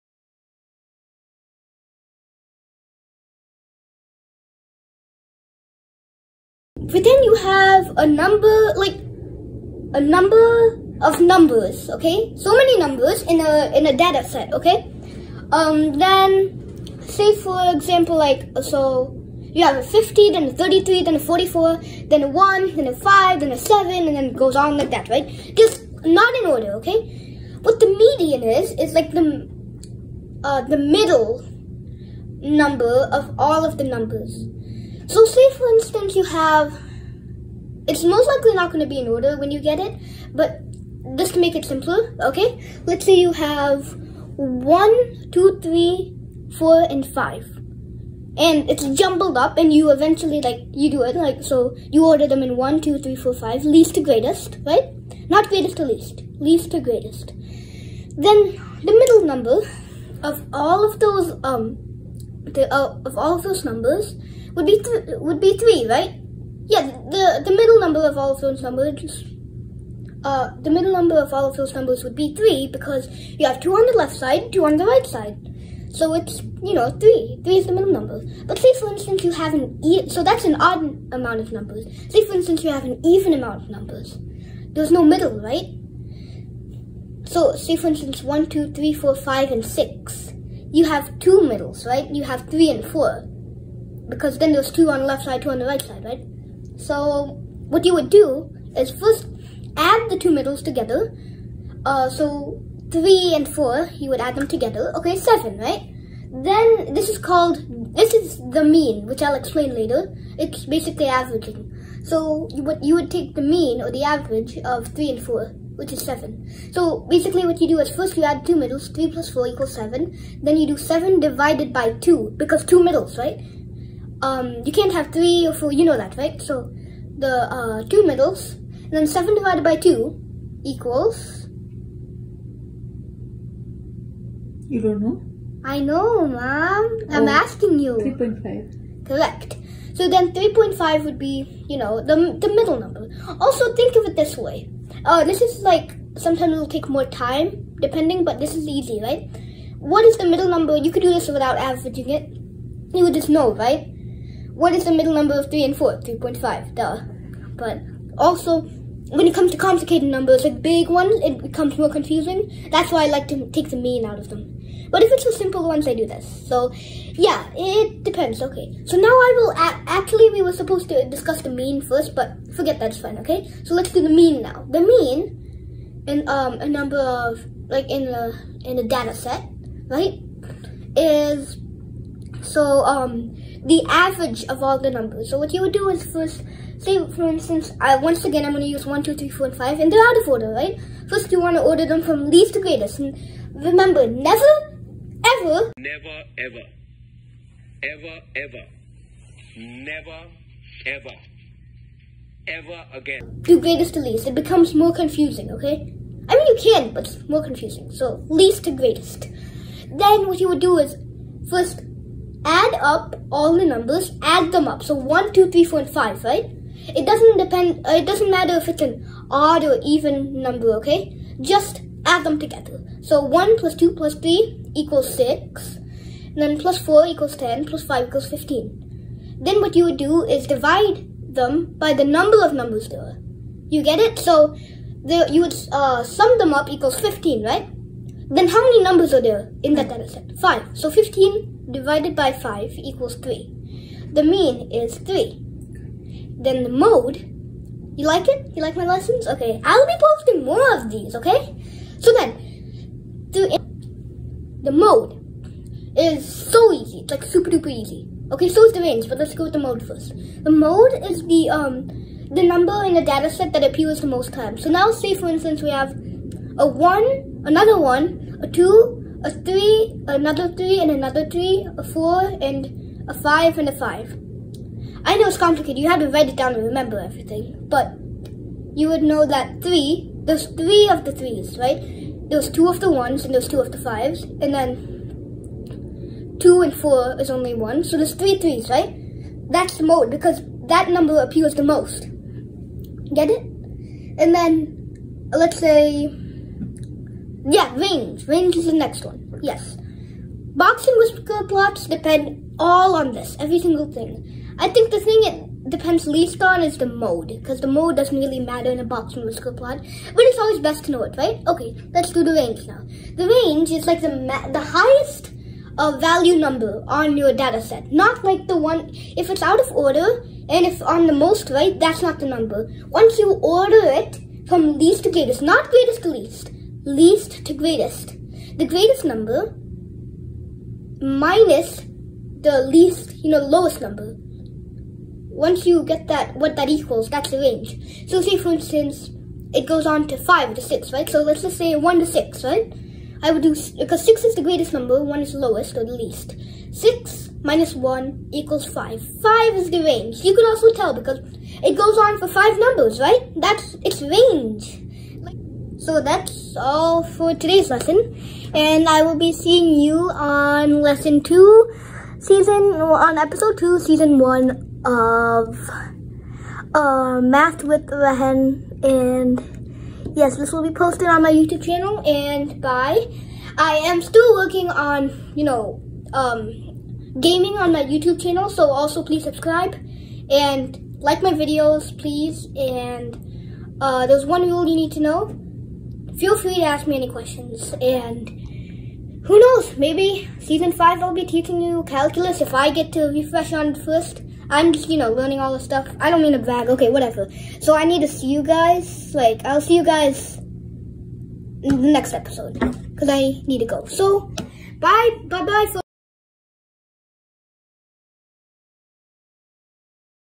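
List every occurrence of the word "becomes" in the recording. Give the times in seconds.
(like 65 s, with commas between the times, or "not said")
161 s, 204 s.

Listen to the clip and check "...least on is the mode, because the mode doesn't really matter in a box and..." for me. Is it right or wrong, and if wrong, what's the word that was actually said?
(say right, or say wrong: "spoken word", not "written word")
right.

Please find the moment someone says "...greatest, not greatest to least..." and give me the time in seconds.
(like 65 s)
325 s.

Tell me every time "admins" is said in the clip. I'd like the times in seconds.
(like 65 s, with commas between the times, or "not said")
not said.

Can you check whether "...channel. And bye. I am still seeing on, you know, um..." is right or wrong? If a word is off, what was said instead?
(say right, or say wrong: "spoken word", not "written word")
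wrong: "working", not "seeing".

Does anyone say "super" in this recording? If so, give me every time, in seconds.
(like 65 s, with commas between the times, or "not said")
257 s.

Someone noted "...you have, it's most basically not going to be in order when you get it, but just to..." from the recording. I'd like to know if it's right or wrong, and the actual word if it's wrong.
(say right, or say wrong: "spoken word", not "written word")
wrong: "likely", not "basically".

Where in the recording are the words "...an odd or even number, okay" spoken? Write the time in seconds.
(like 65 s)
218 s.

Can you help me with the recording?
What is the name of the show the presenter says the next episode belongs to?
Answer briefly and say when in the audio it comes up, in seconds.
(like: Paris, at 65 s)
Math with Rehan, at 367 s.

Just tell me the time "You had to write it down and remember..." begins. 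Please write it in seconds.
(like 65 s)
275 s.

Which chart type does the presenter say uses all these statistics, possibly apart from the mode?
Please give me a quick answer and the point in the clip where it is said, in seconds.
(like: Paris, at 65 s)
Box and whisker plots, at 300 s.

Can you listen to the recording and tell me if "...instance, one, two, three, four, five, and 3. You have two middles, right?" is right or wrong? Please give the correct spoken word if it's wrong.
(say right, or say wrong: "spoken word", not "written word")
wrong: "6", not "3".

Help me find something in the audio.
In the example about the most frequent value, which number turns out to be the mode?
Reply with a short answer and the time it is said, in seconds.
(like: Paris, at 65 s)
3, at 287 s.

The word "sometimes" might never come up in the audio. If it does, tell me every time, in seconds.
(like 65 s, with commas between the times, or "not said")
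146 s.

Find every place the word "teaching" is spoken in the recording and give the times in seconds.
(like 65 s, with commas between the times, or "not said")
391 s.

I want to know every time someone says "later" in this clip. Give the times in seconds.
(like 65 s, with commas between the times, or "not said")
109 s.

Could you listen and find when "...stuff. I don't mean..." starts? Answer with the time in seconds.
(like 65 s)
395 s.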